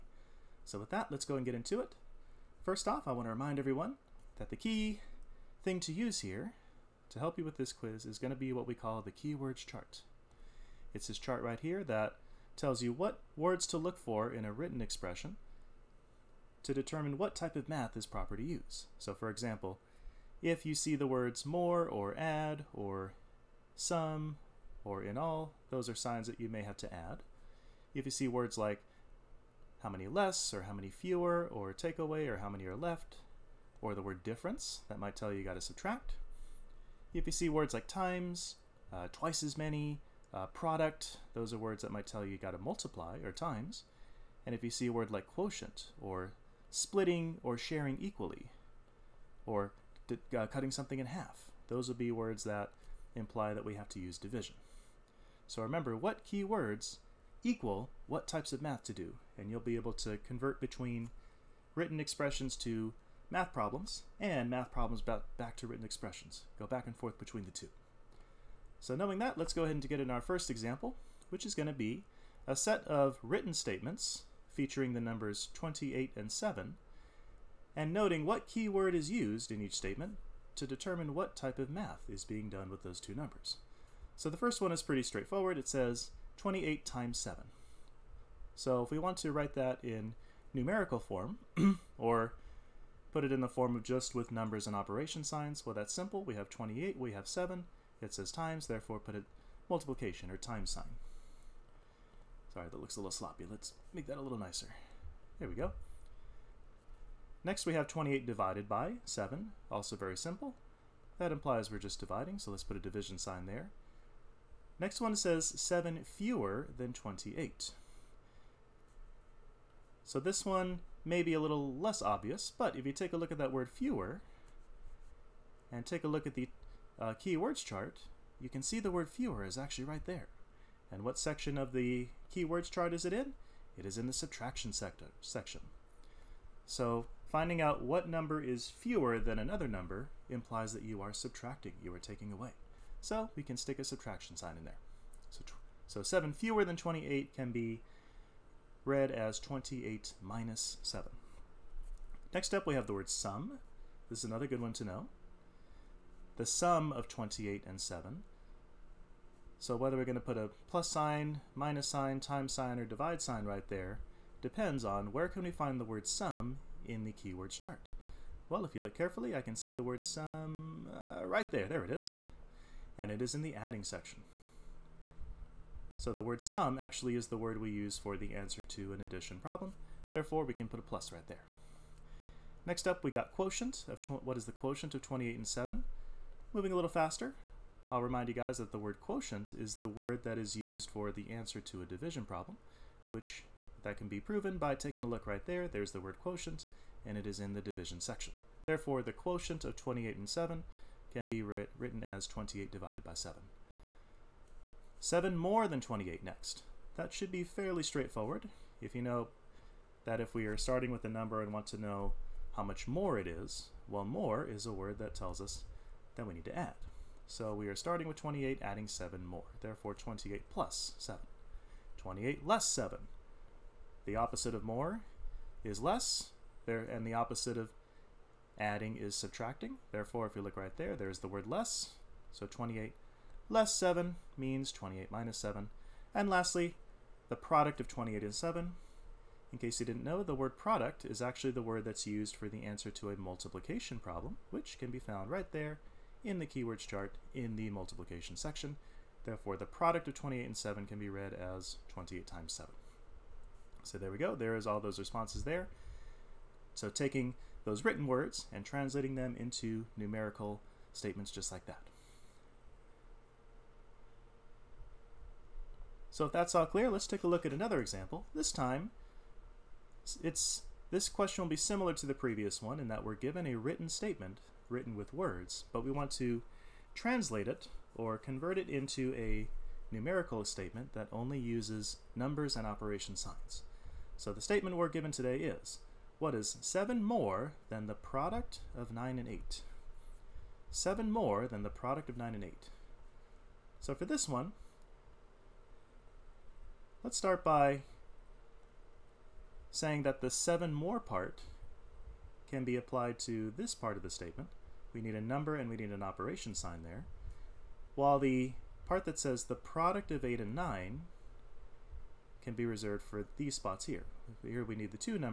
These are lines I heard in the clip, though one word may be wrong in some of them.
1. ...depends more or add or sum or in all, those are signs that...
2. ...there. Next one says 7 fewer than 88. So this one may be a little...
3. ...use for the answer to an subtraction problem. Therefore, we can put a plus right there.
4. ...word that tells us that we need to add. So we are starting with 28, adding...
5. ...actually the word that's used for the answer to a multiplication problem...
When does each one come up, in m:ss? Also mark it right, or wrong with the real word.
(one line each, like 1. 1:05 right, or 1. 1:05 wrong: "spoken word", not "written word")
1. 0:21 wrong: "words", not "depends"
2. 1:53 wrong: "28", not "88"
3. 2:57 wrong: "addition", not "subtraction"
4. 3:34 right
5. 4:01 right.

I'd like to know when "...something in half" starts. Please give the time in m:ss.
0:50.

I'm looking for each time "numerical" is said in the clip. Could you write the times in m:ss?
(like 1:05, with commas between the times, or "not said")
1:30, 4:19, 4:39.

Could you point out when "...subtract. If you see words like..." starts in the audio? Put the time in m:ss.
0:35.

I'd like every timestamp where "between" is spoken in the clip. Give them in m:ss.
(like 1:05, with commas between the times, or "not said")
1:00, 1:07.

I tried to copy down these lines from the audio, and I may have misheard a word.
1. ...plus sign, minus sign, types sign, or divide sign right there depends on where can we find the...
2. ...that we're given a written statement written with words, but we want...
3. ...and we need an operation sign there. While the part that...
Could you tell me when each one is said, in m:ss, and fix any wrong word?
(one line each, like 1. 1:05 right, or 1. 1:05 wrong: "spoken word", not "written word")
1. 2:40 wrong: "times", not "types"
2. 4:32 right
3. 5:05 right.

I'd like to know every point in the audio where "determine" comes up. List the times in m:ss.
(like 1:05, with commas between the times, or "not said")
0:16, 1:20.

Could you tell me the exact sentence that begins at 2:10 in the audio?
And what section of the keywords chart is it in?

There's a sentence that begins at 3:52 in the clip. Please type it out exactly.
So 28 less 7 means 28 minus 7.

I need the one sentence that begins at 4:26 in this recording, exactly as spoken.
So if that's all clear, let's take a look at another example.